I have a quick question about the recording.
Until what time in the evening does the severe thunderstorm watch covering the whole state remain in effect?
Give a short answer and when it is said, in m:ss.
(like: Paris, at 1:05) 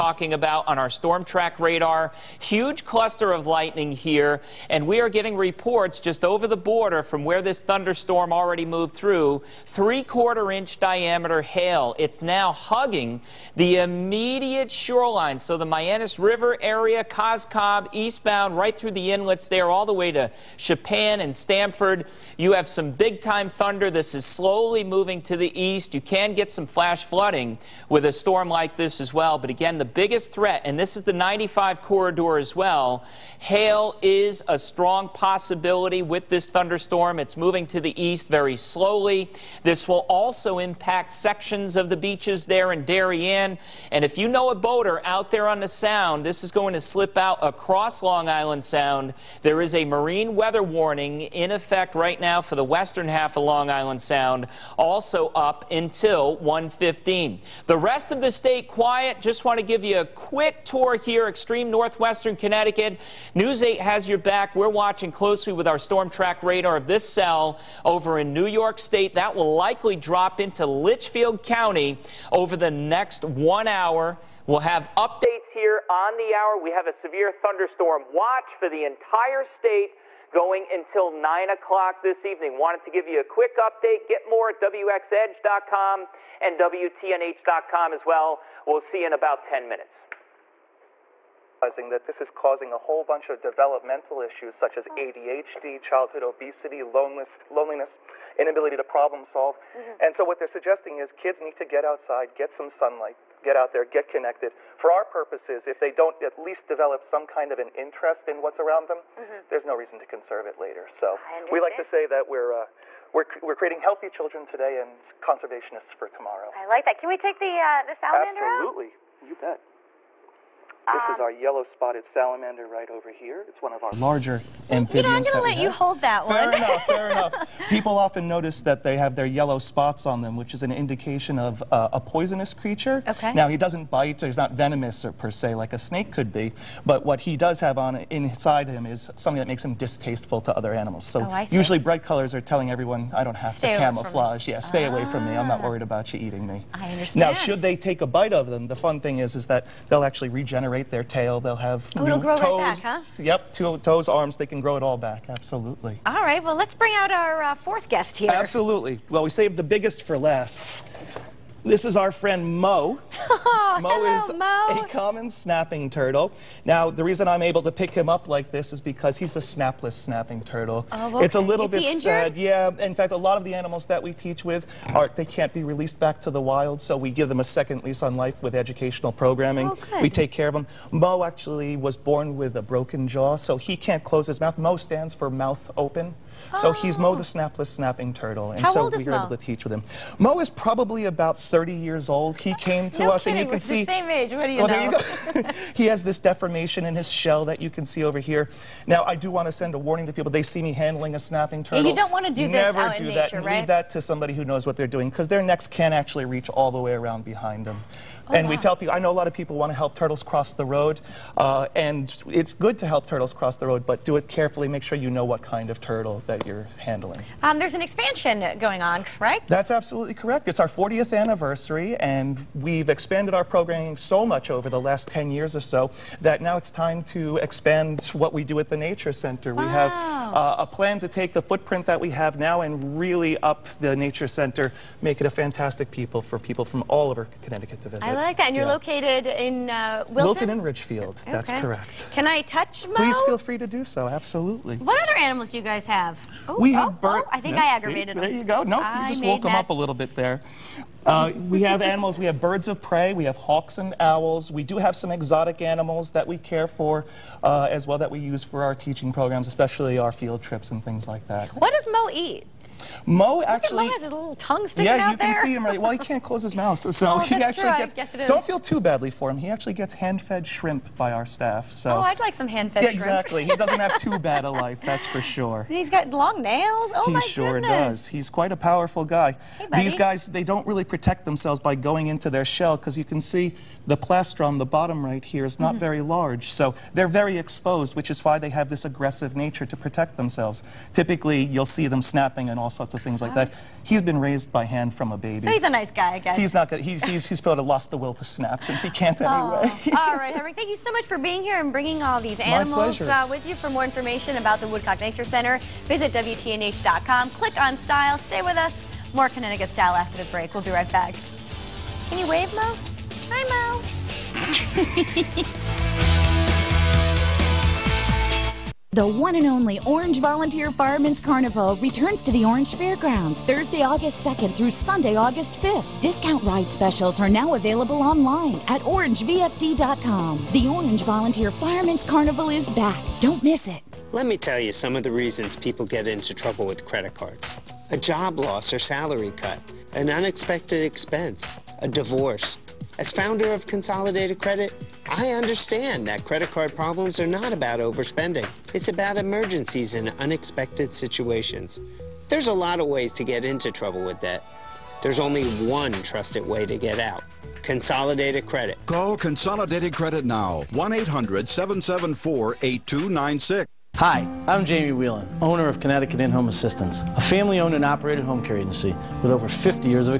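9 o'clock, at 1:21.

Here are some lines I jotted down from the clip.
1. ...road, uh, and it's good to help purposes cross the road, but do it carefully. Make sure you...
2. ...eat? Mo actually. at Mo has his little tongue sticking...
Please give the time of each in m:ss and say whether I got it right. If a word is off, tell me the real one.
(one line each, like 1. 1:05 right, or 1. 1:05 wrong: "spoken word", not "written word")
1. 3:30 wrong: "turtles", not "purposes"
2. 4:22 right.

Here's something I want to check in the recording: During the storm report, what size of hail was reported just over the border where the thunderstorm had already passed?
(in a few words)
Three-quarter inch.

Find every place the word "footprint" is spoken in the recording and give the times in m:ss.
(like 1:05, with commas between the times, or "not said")
3:51.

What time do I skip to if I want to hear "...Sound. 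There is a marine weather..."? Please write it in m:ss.
0:48.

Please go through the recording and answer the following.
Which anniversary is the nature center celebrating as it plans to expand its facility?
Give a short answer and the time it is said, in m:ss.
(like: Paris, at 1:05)
40th, at 3:40.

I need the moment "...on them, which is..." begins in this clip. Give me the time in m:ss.
2:10.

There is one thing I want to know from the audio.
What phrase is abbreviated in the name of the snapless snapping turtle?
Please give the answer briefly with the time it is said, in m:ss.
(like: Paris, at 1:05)
mouth open, at 3:05.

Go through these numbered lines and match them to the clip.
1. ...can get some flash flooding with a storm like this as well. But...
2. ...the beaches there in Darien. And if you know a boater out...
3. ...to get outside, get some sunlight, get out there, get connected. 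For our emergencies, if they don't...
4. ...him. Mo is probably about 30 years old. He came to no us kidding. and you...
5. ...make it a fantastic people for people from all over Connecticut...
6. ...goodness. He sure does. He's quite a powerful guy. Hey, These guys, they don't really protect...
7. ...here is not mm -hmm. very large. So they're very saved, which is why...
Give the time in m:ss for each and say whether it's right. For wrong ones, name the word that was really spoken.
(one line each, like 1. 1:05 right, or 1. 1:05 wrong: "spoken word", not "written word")
1. 0:25 right
2. 0:41 right
3. 1:41 wrong: "purposes", not "emergencies"
4. 3:09 right
5. 3:54 right
6. 4:37 right
7. 4:45 wrong: "exposed", not "saved".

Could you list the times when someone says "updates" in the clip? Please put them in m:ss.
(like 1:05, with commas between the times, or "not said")
1:14, 1:23.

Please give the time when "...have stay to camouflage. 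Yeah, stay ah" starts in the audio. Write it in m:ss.
2:23.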